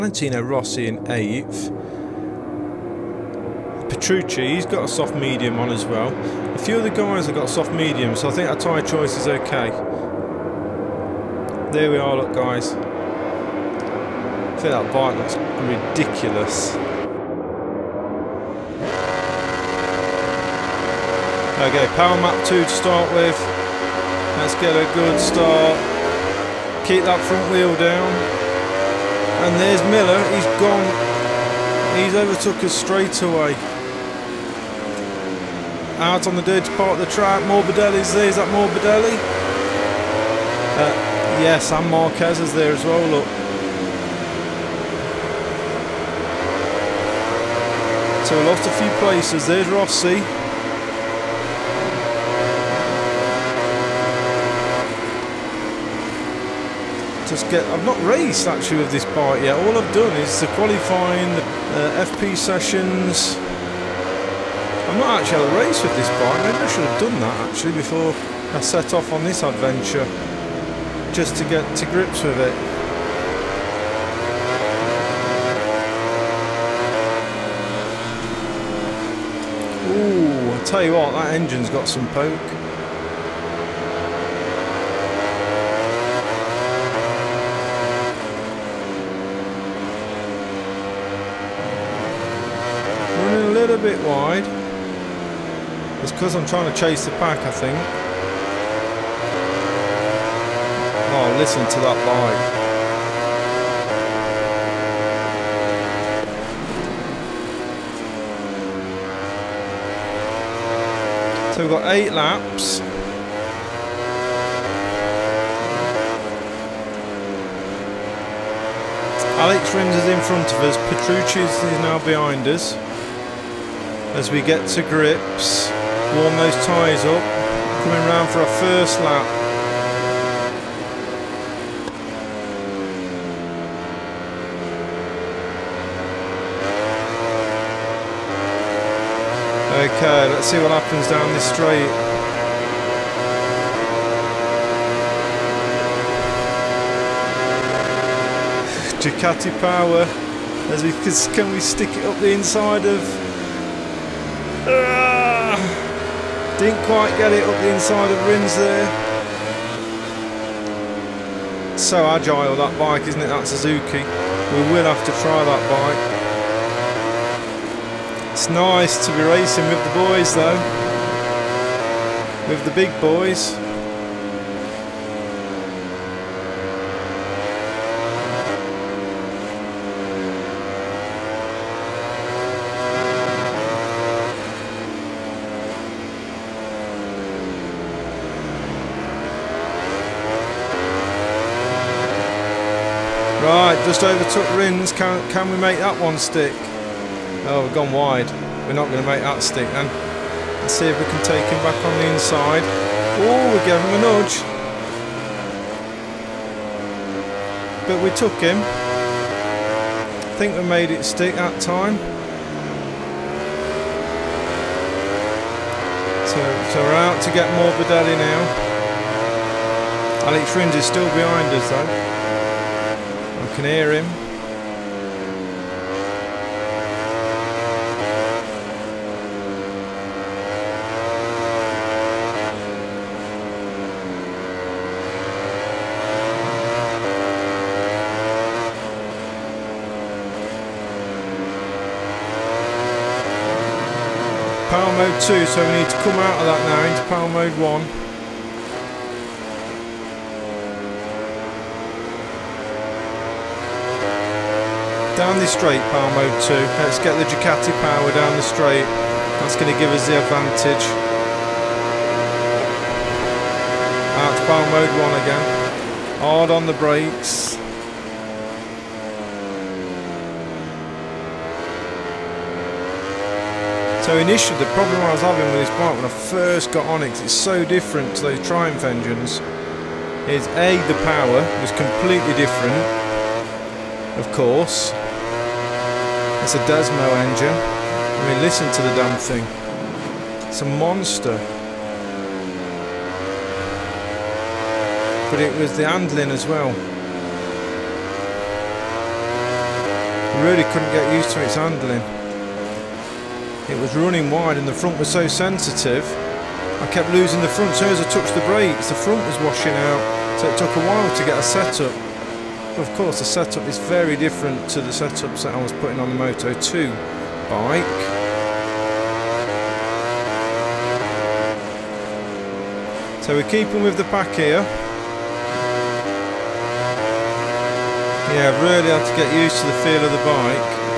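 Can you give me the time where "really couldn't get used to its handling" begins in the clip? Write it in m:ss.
5:00.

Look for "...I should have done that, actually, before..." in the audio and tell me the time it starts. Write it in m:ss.
1:06.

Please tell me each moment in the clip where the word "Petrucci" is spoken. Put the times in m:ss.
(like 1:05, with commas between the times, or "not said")
0:03, 2:00.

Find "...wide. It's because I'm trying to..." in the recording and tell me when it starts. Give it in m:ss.
1:34.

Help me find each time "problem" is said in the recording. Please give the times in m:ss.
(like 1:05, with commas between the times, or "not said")
4:34.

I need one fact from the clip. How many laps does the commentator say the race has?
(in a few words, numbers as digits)
8.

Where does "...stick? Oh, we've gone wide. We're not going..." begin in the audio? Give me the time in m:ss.
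3:16.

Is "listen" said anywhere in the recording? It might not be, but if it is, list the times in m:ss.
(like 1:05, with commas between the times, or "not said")
1:41, 4:48.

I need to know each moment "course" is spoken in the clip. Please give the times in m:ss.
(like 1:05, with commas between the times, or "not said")
4:44, 5:12.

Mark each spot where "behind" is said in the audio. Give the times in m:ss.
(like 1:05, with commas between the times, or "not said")
2:02, 3:41.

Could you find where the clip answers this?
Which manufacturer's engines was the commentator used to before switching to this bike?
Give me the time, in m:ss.
4:38.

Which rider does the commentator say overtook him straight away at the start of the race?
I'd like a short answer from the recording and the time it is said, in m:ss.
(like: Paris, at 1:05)
Miller, at 0:29.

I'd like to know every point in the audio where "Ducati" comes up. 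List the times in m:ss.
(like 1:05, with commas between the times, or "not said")
2:29, 4:17.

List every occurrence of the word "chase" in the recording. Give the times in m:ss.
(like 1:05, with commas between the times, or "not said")
1:36.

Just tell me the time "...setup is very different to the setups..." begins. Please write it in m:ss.
5:13.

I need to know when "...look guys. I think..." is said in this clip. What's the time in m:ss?
0:12.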